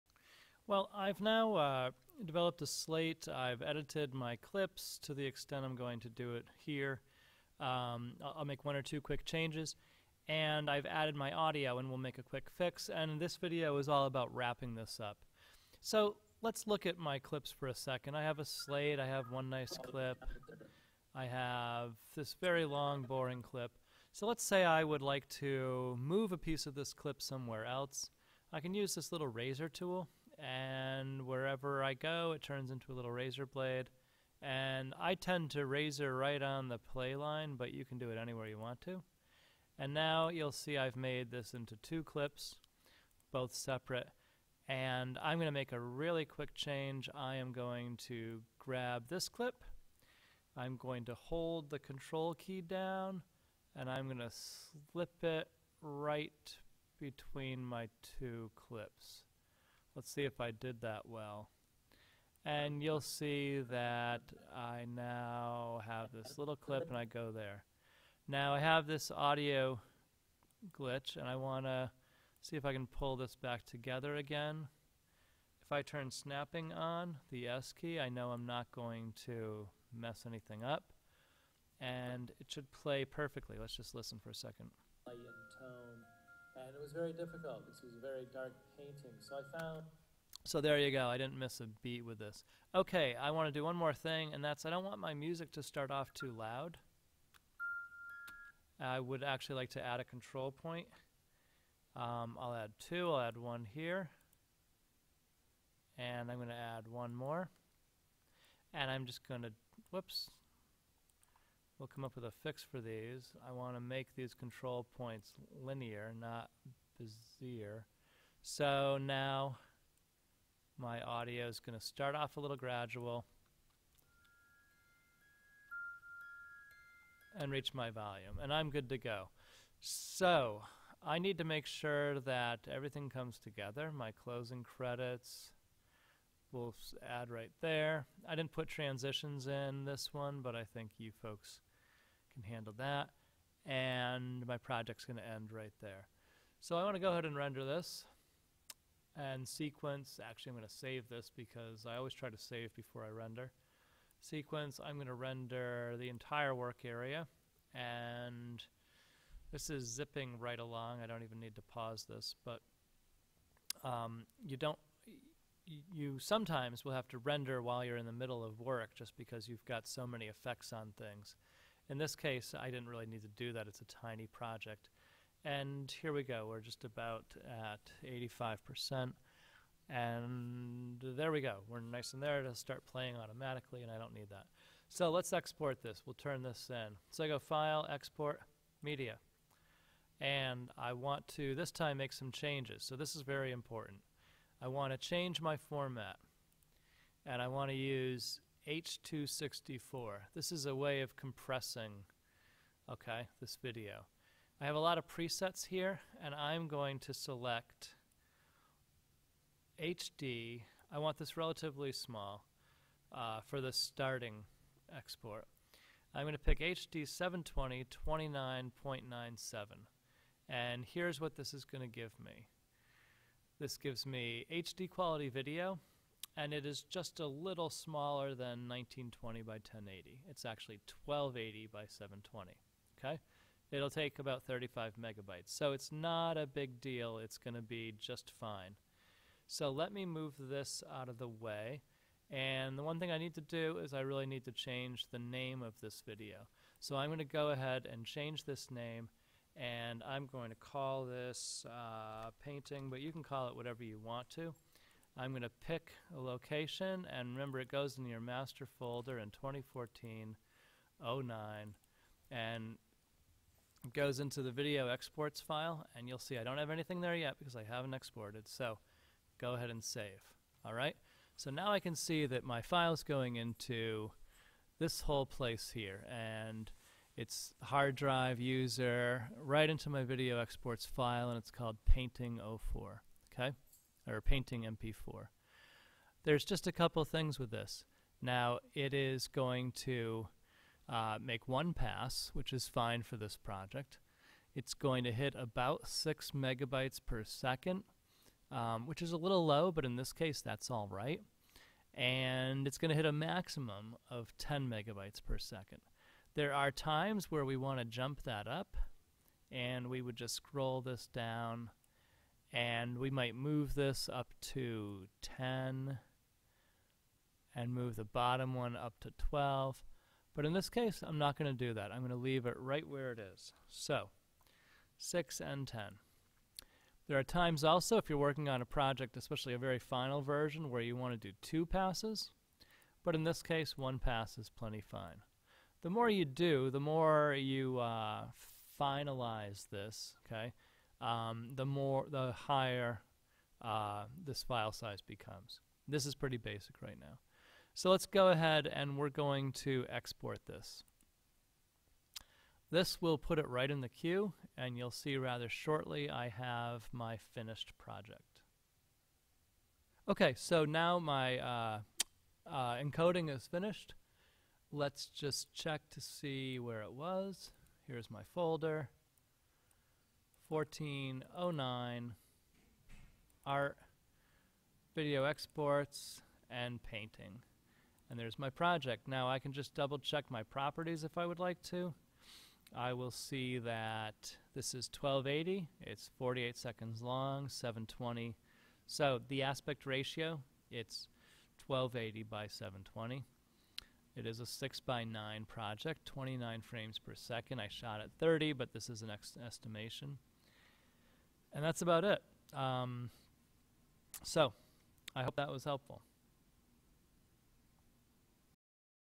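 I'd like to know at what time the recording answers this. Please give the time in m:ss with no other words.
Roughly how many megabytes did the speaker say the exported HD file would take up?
3:54.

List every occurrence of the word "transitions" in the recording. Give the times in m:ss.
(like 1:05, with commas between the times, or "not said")
2:18.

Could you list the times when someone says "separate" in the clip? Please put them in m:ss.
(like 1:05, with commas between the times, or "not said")
0:43.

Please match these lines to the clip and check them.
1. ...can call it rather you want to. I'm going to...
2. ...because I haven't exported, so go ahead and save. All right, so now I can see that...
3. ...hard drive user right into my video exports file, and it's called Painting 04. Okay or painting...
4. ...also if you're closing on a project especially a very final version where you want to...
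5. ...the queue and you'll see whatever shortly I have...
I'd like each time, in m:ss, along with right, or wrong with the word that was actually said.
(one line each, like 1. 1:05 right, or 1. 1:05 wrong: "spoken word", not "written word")
1. 4:13 wrong: "whatever", not "rather"
2. 4:27 right
3. 4:37 right
4. 5:27 wrong: "working", not "closing"
5. 5:53 wrong: "rather", not "whatever".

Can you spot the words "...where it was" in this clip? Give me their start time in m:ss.
6:06.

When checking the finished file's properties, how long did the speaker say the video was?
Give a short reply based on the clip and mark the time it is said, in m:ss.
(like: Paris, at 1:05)
48 seconds, at 6:26.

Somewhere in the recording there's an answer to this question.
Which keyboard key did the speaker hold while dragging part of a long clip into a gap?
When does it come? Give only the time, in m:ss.
0:51.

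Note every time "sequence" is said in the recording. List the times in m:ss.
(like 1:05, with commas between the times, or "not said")
2:29, 2:34.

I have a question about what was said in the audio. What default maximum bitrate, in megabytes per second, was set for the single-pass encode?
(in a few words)
10.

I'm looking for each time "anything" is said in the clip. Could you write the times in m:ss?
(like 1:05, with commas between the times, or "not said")
1:20, 4:26.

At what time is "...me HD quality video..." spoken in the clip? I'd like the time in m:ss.
3:44.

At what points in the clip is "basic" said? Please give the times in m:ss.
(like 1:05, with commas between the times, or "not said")
5:46.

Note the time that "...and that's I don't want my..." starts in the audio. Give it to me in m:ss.
1:34.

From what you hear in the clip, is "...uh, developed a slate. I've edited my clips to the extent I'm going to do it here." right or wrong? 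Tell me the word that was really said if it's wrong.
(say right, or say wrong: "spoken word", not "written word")
right.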